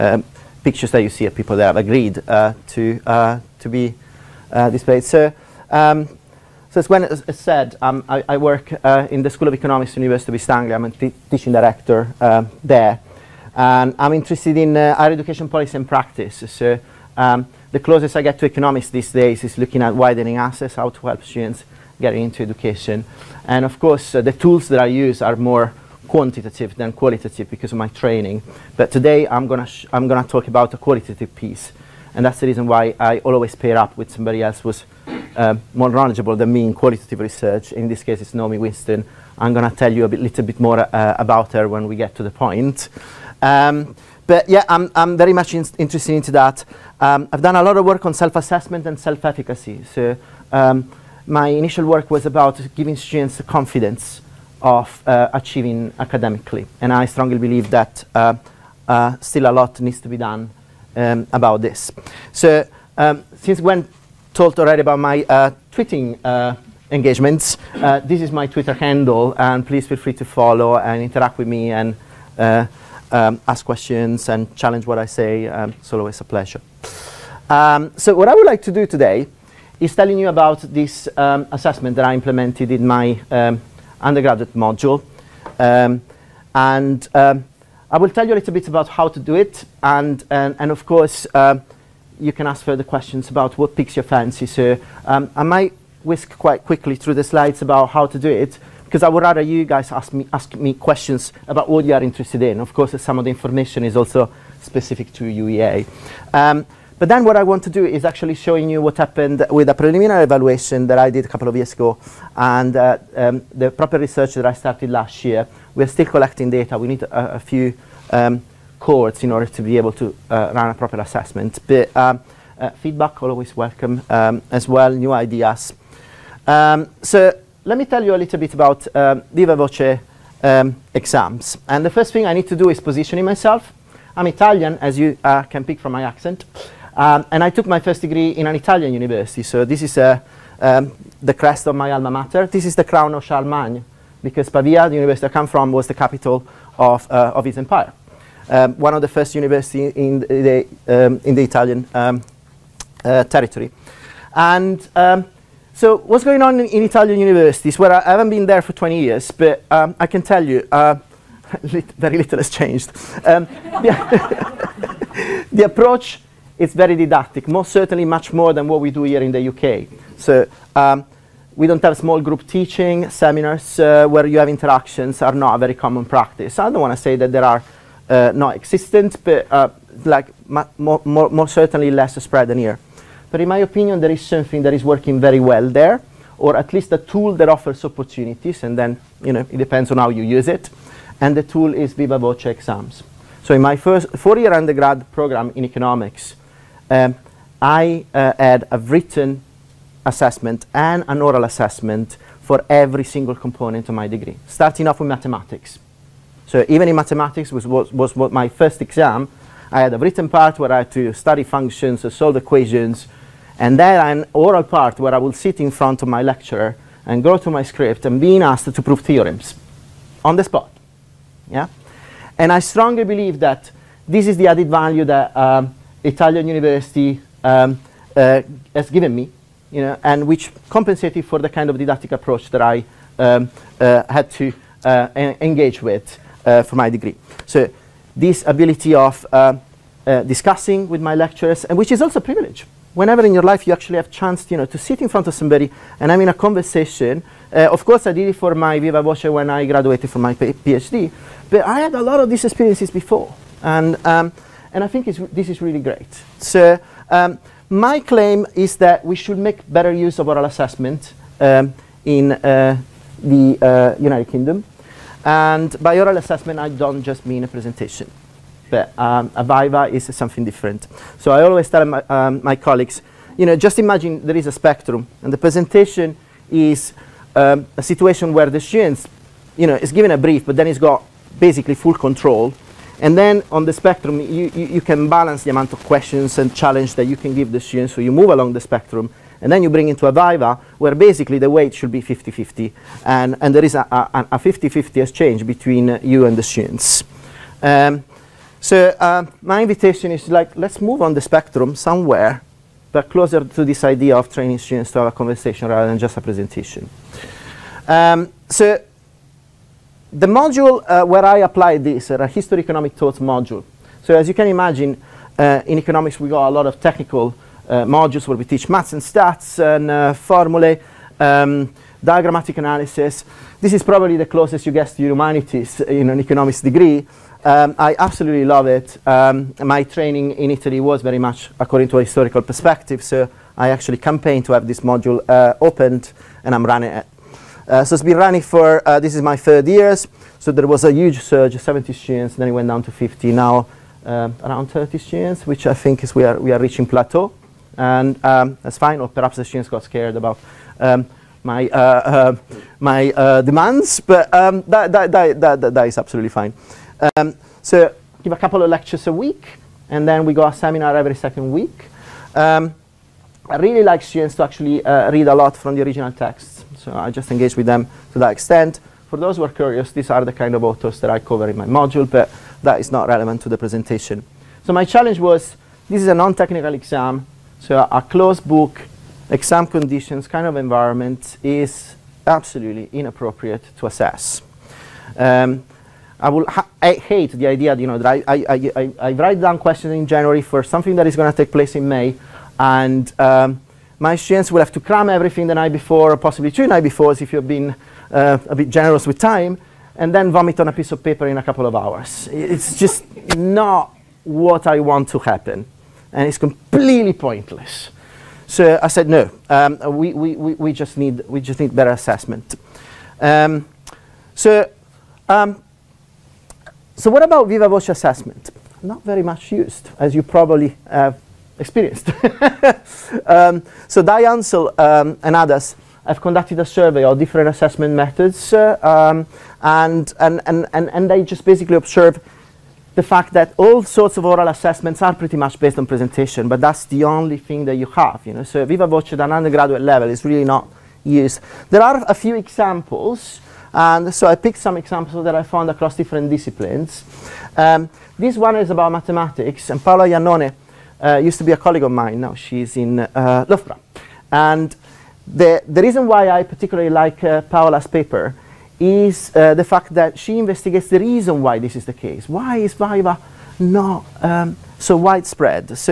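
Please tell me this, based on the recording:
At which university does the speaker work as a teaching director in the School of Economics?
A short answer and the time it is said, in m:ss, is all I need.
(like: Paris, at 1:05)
University of East Anglia, at 0:09.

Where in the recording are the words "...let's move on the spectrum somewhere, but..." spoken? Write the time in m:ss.
5:00.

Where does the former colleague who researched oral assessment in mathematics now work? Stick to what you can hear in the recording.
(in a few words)
Loughborough.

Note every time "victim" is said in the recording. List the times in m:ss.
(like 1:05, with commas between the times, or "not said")
not said.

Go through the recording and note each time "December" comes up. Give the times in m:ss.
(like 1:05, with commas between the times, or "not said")
not said.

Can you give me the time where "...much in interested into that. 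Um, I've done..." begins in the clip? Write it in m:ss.
0:45.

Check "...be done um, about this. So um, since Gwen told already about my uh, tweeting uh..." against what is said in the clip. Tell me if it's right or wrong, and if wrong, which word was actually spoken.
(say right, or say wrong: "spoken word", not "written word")
right.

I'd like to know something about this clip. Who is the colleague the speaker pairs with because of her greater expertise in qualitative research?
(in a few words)
Naomi Winstone.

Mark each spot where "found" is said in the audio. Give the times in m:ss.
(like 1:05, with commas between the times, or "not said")
7:25.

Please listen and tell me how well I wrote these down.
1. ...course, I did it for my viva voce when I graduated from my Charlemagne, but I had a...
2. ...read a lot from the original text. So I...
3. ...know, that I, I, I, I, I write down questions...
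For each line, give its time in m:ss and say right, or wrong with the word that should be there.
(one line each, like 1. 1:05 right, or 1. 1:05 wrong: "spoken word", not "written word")
1. 4:07 wrong: "PhD", not "Charlemagne"
2. 6:05 right
3. 6:27 right.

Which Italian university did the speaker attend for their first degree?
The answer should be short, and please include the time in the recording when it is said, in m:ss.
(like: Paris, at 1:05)
Pavia, at 2:24.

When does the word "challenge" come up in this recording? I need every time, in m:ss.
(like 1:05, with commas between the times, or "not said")
1:14, 4:46, 6:14.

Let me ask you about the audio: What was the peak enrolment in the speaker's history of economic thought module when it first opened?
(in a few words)
70 students.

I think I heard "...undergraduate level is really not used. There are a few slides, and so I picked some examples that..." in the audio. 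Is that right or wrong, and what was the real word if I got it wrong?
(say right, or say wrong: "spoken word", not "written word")
wrong: "examples", not "slides".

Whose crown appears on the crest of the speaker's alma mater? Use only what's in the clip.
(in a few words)
Charlemagne.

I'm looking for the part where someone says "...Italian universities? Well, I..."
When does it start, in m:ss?
2:36.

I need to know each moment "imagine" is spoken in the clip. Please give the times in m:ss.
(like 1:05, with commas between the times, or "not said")
4:33, 5:14.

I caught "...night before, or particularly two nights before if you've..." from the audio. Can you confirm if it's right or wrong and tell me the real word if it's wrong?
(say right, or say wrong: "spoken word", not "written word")
wrong: "possibly", not "particularly".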